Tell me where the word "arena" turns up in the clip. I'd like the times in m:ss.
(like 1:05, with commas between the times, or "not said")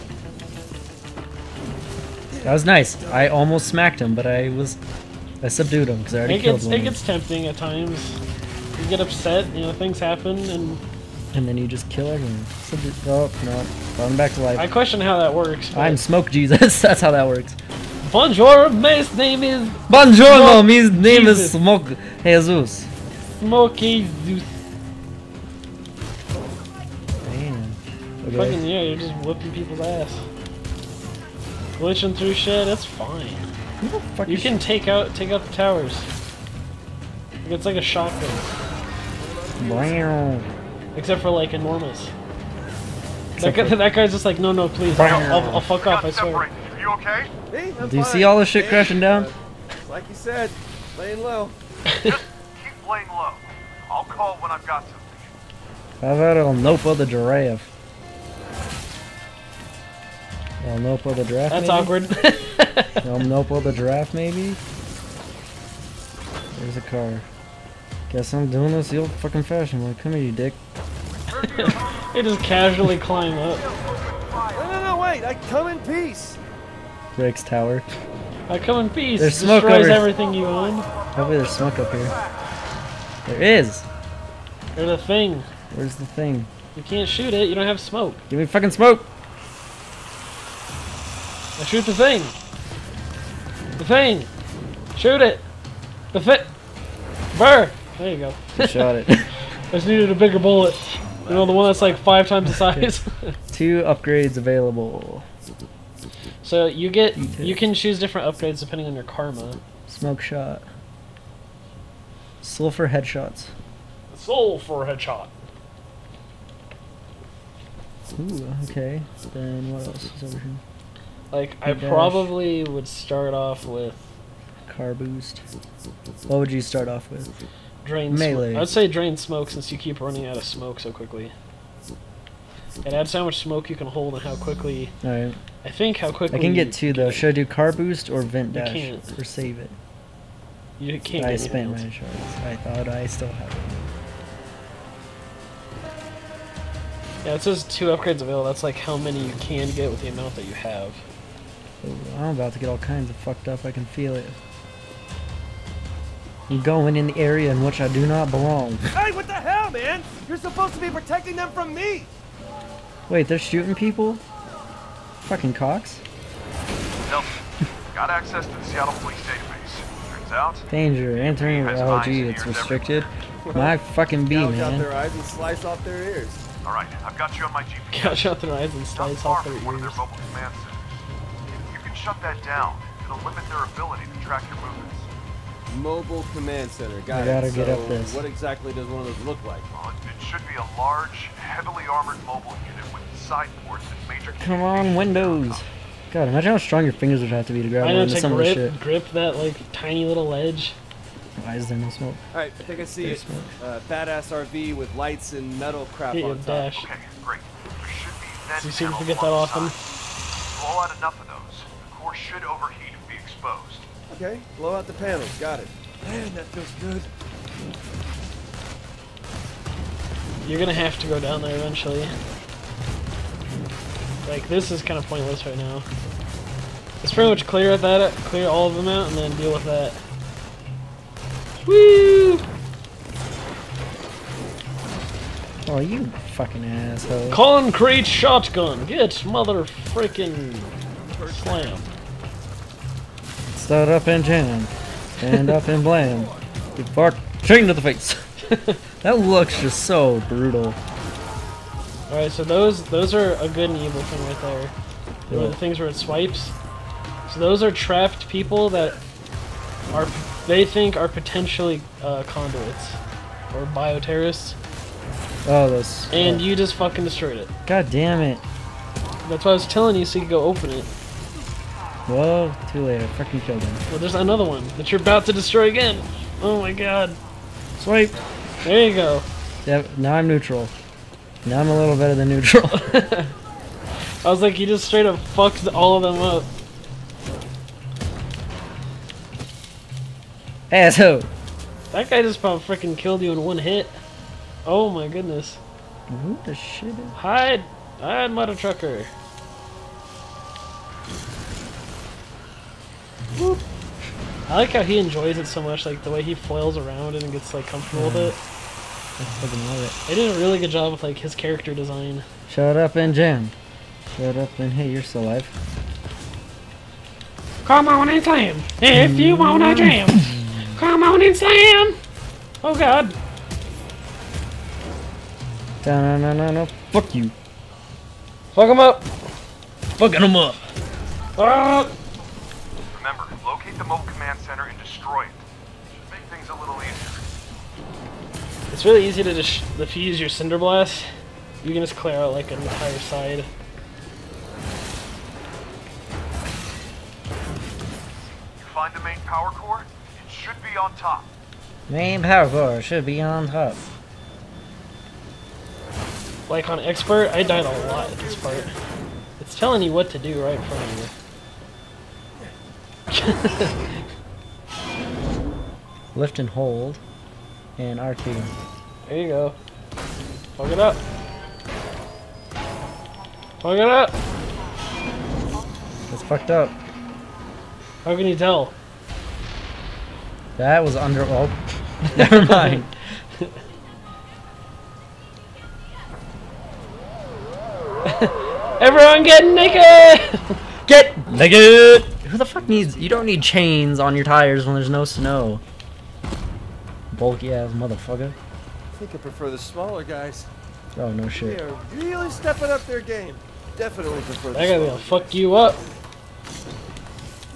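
not said.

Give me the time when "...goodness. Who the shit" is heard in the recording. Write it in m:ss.
4:55.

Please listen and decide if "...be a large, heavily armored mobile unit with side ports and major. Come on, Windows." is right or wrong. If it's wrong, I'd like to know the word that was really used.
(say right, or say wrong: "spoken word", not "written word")
right.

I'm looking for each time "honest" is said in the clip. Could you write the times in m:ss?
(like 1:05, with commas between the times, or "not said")
not said.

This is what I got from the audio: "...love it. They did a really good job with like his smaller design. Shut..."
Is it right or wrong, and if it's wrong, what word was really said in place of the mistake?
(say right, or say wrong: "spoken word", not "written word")
wrong: "character", not "smaller".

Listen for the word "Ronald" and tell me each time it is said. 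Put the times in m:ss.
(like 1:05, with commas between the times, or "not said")
not said.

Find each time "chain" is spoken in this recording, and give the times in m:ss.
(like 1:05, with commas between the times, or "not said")
4:07, 6:33.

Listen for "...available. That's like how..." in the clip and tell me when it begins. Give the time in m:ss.
2:28.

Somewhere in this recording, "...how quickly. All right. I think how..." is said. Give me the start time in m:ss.
2:14.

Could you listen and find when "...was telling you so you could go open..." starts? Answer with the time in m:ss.
4:29.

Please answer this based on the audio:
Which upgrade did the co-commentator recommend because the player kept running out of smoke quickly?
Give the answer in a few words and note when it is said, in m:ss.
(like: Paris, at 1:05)
drain smoke, at 2:08.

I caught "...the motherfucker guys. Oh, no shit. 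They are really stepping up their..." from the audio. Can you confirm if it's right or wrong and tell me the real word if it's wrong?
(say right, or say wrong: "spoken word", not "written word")
wrong: "smaller", not "motherfucker".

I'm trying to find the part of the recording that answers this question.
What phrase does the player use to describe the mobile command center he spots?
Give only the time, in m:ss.
3:23.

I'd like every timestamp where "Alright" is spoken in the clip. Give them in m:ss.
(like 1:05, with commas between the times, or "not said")
2:56, 3:22.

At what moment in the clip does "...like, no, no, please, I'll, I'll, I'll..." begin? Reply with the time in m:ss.
0:44.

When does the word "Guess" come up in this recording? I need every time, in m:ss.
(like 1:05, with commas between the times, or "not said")
1:08.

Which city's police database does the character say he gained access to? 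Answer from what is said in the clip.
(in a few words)
Seattle.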